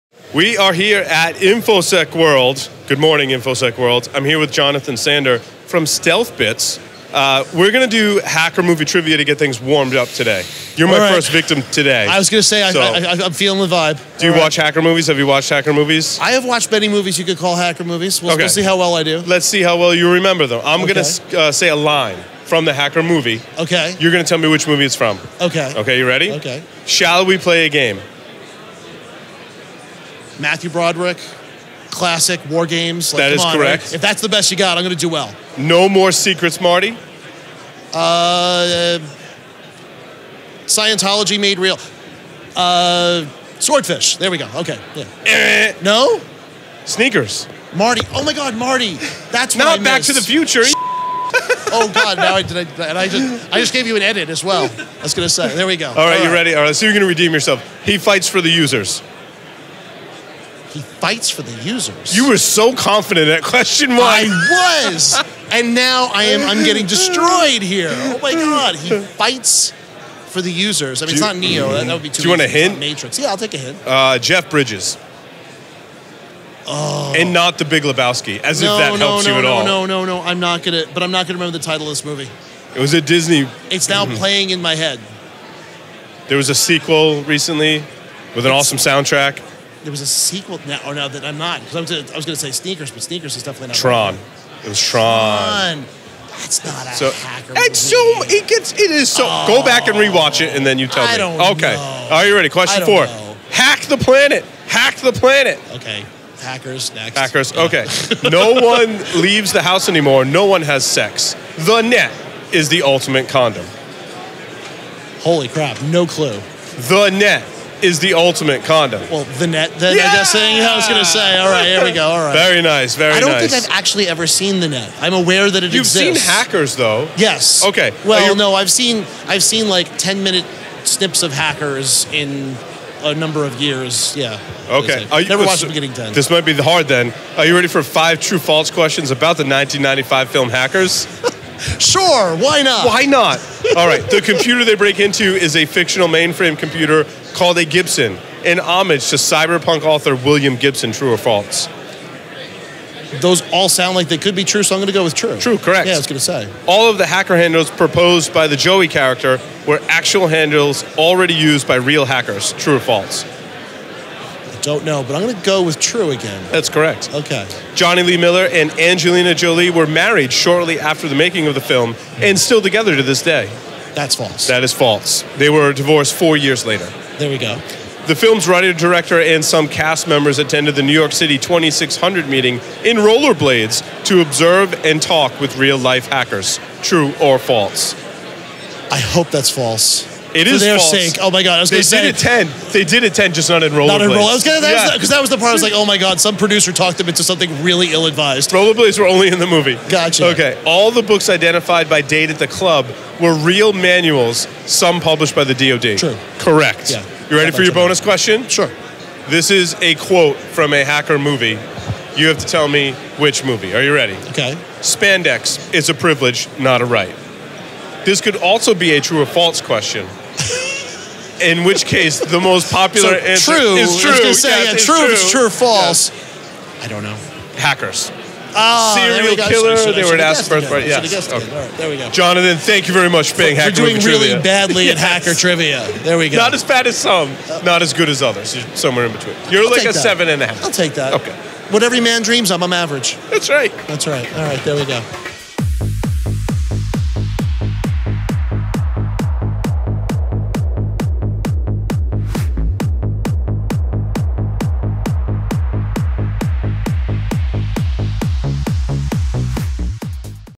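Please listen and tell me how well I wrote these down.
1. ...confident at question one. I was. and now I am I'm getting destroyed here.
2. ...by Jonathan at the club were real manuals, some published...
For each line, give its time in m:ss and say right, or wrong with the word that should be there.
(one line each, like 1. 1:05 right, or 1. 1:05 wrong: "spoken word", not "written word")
1. 1:02 right
2. 3:21 wrong: "Dade", not "Jonathan".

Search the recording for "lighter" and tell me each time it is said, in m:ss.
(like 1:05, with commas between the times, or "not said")
not said.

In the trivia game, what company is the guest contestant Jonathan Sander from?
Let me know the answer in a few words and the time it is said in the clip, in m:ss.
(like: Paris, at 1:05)
STEALTHbits, at 0:05.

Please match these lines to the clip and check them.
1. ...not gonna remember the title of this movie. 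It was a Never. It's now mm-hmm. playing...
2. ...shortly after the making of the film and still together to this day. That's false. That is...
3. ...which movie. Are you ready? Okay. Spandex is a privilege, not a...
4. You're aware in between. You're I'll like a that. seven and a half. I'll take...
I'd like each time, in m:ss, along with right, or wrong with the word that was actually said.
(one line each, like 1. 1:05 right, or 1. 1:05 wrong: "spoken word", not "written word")
1. 1:21 wrong: "Disney", not "Never"
2. 2:50 right
3. 3:33 right
4. 3:58 wrong: "somewhere", not "aware".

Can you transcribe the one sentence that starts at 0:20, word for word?
going to uh, say a line from the hacker movie.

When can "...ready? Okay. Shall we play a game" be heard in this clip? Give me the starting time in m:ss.
0:26.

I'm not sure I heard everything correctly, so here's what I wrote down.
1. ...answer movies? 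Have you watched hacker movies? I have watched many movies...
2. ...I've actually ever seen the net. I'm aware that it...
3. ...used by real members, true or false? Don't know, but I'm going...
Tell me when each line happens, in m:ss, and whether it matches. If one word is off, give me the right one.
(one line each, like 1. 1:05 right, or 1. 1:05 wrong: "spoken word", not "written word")
1. 0:14 wrong: "hacker", not "answer"
2. 2:03 right
3. 2:41 wrong: "hackers", not "members".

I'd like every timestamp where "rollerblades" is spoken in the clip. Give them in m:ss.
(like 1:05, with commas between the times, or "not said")
3:02, 3:13, 3:18.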